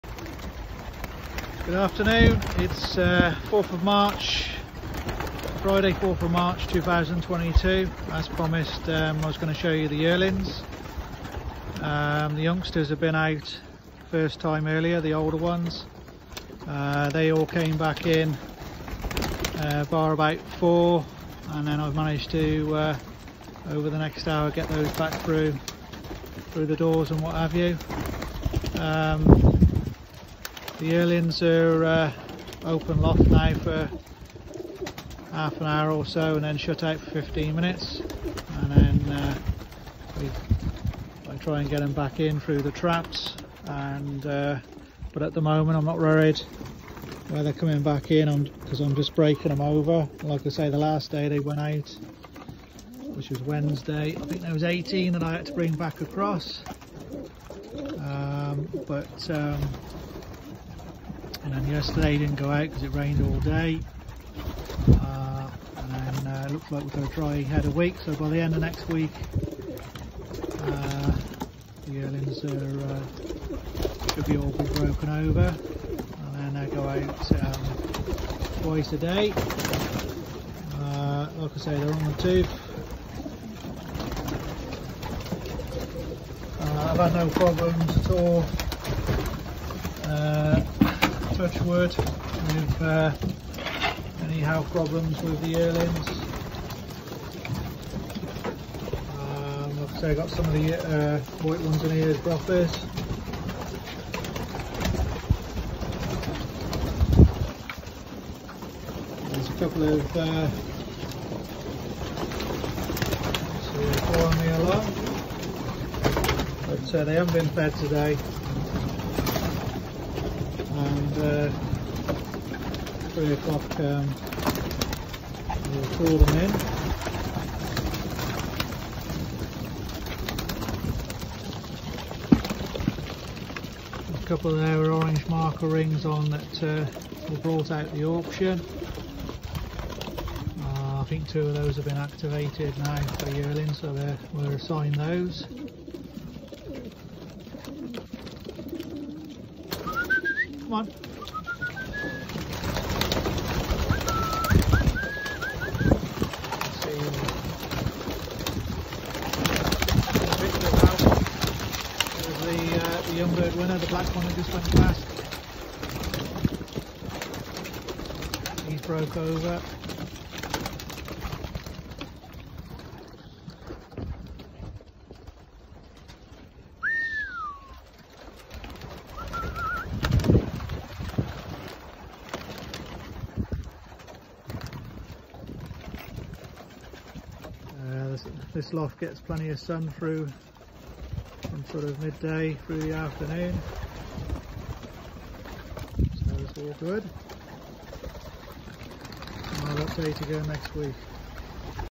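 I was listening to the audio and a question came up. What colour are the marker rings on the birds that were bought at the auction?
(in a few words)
orange.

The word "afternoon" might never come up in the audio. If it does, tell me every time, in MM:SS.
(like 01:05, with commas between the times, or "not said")
00:01, 03:12.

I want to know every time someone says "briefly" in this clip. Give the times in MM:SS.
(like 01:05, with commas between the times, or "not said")
not said.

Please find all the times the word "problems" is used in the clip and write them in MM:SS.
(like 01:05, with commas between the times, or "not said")
01:27, 01:34.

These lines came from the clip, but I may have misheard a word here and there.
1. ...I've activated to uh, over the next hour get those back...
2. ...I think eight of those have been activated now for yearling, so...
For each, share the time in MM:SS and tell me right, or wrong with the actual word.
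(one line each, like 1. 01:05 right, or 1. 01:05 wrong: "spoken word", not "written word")
1. 00:21 wrong: "managed", not "activated"
2. 02:21 wrong: "two", not "eight".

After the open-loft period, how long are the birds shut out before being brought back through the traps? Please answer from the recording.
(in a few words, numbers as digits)
15 minutes.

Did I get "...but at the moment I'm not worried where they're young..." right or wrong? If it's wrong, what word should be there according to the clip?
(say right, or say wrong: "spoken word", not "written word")
wrong: "coming", not "young".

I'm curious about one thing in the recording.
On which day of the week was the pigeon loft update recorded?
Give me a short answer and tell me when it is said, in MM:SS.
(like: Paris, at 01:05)
Friday, at 00:05.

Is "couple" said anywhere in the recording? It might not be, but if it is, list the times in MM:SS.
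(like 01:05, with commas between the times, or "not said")
01:49, 02:14.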